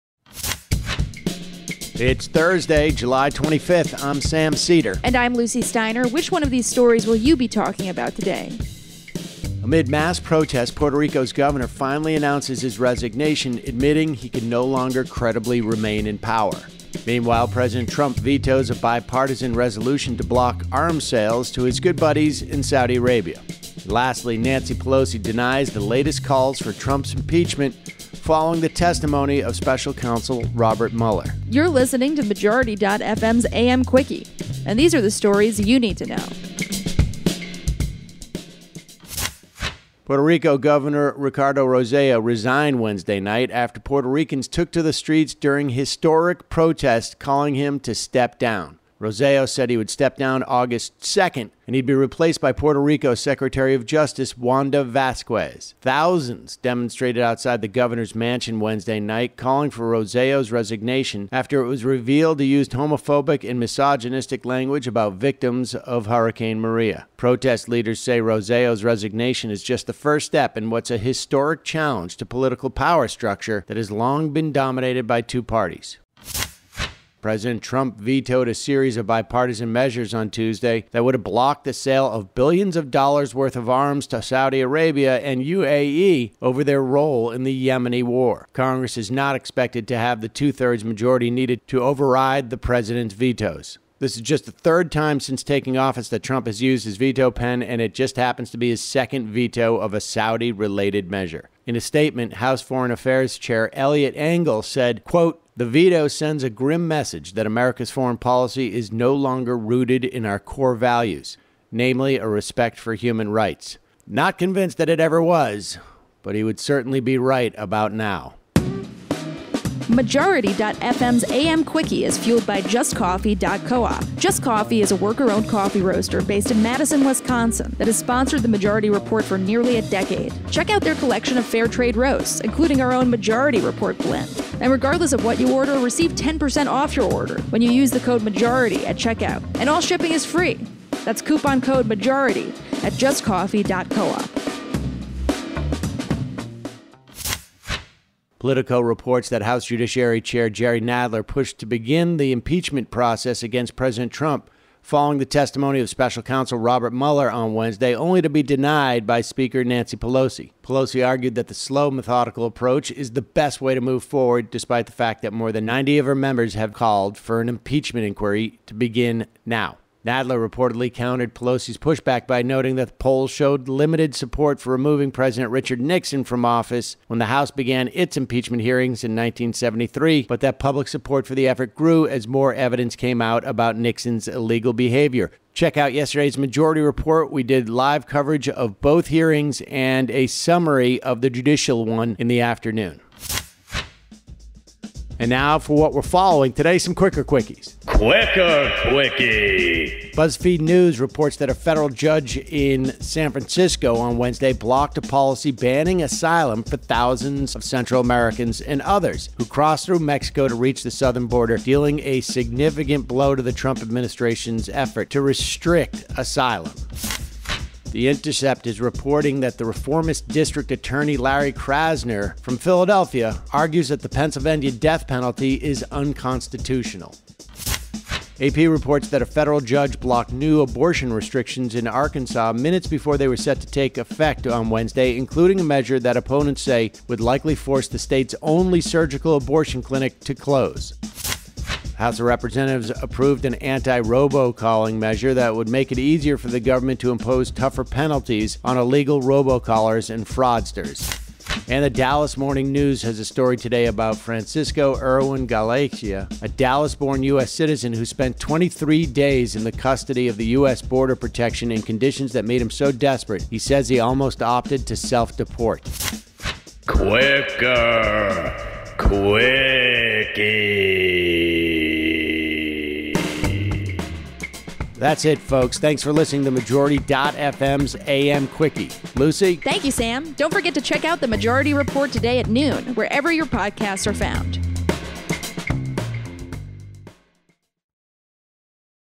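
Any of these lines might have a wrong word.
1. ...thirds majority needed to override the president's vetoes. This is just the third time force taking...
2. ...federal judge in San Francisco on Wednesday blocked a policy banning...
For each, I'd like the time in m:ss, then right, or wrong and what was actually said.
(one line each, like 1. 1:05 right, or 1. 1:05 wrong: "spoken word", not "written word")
1. 1:30 wrong: "since", not "force"
2. 3:21 right.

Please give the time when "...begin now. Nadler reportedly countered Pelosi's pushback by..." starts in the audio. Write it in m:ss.
2:48.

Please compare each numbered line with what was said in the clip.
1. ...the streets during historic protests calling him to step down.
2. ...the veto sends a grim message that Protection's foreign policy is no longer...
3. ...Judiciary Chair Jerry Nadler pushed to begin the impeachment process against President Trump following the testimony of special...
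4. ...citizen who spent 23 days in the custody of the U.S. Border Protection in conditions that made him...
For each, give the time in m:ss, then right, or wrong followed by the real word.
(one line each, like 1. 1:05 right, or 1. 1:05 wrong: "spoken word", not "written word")
1. 0:44 right
2. 1:45 wrong: "America", not "Protection"
3. 2:29 right
4. 4:17 right.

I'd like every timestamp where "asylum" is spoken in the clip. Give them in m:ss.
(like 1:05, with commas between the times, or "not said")
3:26, 3:36.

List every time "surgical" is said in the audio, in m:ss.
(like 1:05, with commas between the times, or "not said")
3:58.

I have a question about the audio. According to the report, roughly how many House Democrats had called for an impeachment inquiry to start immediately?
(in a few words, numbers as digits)
more than 90.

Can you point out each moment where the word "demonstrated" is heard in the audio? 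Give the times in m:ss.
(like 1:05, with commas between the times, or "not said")
0:56.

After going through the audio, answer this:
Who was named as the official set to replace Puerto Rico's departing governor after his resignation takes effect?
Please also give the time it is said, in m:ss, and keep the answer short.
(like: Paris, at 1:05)
Wanda Vasquez, at 0:54.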